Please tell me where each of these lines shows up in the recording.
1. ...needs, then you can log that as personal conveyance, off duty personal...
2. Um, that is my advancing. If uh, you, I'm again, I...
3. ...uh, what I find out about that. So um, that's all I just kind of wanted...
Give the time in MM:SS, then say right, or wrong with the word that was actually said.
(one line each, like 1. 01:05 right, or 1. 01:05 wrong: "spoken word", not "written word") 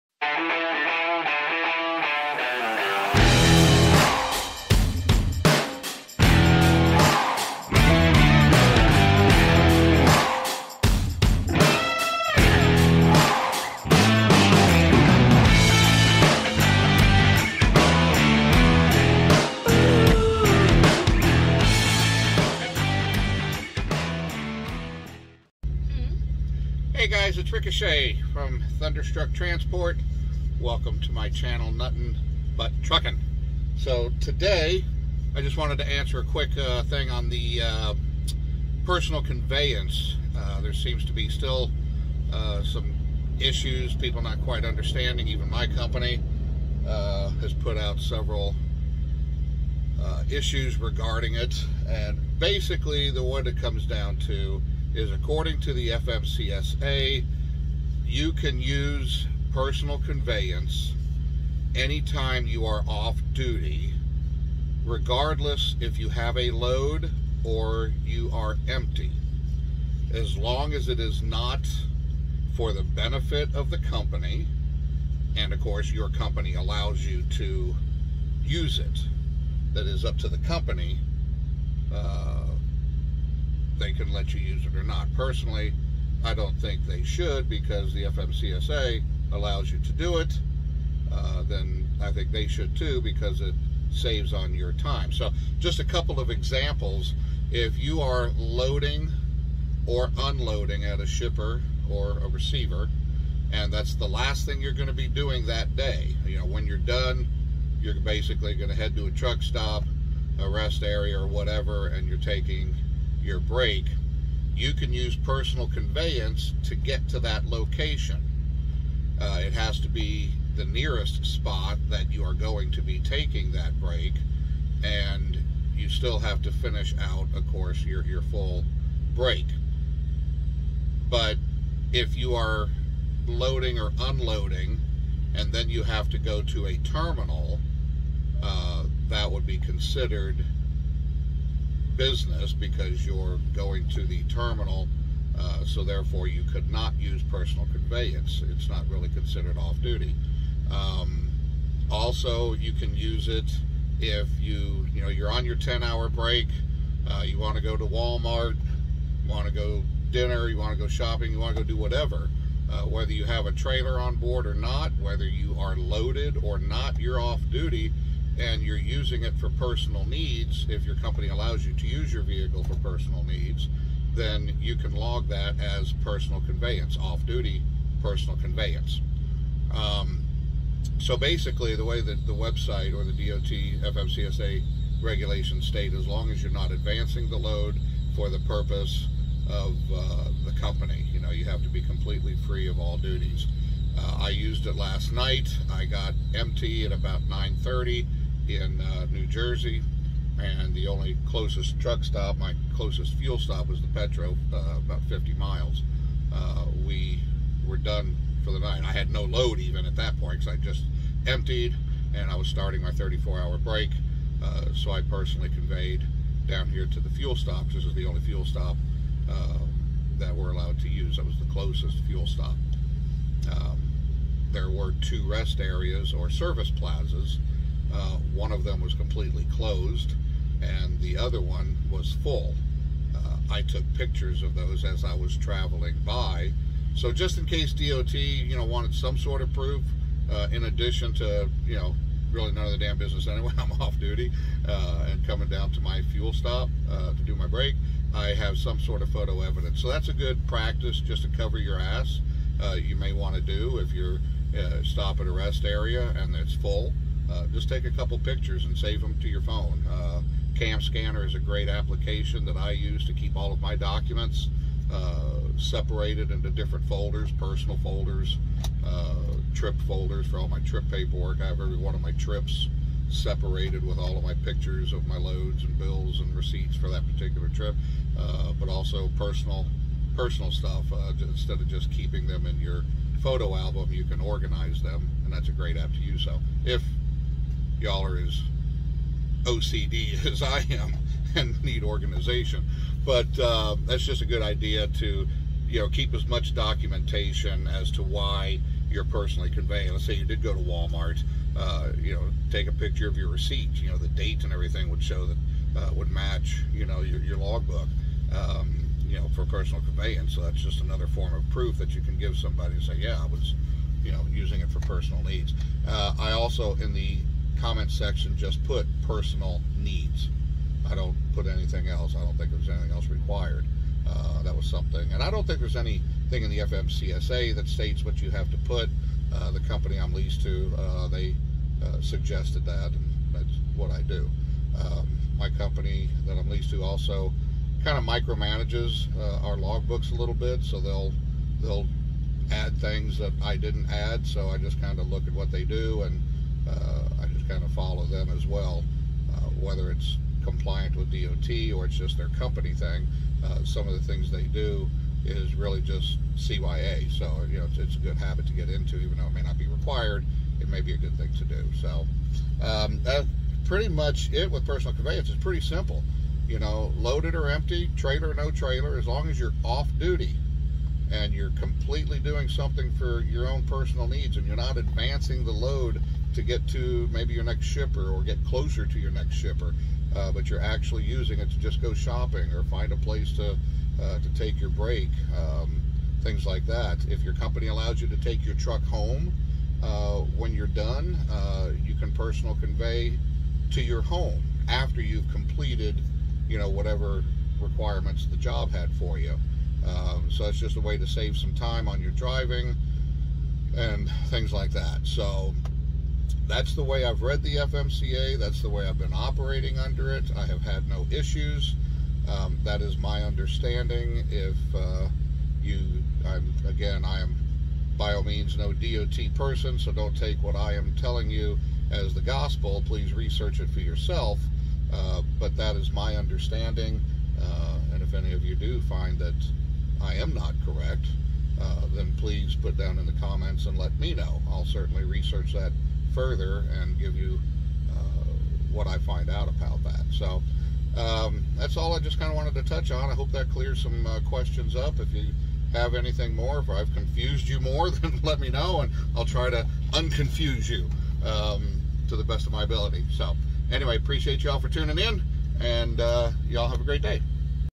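1. 02:53 right
2. 06:52 wrong: "understanding", not "advancing"
3. 07:17 right.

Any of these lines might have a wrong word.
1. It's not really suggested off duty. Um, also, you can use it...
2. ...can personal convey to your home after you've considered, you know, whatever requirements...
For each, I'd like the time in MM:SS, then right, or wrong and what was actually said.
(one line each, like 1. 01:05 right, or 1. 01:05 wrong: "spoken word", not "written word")
1. 02:28 wrong: "considered", not "suggested"
2. 06:31 wrong: "completed", not "considered".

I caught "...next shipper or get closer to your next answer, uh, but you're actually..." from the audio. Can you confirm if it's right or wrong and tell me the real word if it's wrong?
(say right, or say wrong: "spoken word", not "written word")
wrong: "shipper", not "answer".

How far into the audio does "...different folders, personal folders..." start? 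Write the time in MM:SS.
04:26.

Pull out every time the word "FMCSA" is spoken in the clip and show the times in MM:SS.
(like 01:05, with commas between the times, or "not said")
00:55, 01:28, 03:03, 05:26.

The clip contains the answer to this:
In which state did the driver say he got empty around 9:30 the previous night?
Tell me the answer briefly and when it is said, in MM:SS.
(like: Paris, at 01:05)
New Jersey, at 03:19.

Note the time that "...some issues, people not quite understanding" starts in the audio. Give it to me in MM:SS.
00:42.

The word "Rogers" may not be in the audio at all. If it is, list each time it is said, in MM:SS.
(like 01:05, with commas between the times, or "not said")
not said.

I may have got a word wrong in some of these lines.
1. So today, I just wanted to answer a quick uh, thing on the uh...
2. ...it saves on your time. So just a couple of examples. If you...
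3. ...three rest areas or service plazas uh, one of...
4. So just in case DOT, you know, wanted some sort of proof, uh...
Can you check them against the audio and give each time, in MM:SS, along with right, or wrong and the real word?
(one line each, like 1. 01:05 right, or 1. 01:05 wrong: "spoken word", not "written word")
1. 00:33 right
2. 01:33 right
3. 03:45 wrong: "two", not "three"
4. 03:56 right.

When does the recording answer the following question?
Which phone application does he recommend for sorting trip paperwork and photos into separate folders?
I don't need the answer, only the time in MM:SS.
04:20.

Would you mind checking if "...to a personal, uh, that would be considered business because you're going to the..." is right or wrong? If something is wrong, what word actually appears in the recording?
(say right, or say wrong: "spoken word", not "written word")
wrong: "terminal", not "personal".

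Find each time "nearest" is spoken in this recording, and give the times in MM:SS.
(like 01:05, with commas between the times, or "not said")
02:00.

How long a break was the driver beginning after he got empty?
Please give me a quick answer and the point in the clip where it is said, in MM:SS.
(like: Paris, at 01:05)
34 hours, at 03:32.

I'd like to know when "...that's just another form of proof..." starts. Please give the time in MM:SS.
05:10.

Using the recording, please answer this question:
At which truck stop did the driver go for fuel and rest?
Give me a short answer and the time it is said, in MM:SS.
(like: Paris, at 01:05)
Petro, at 03:23.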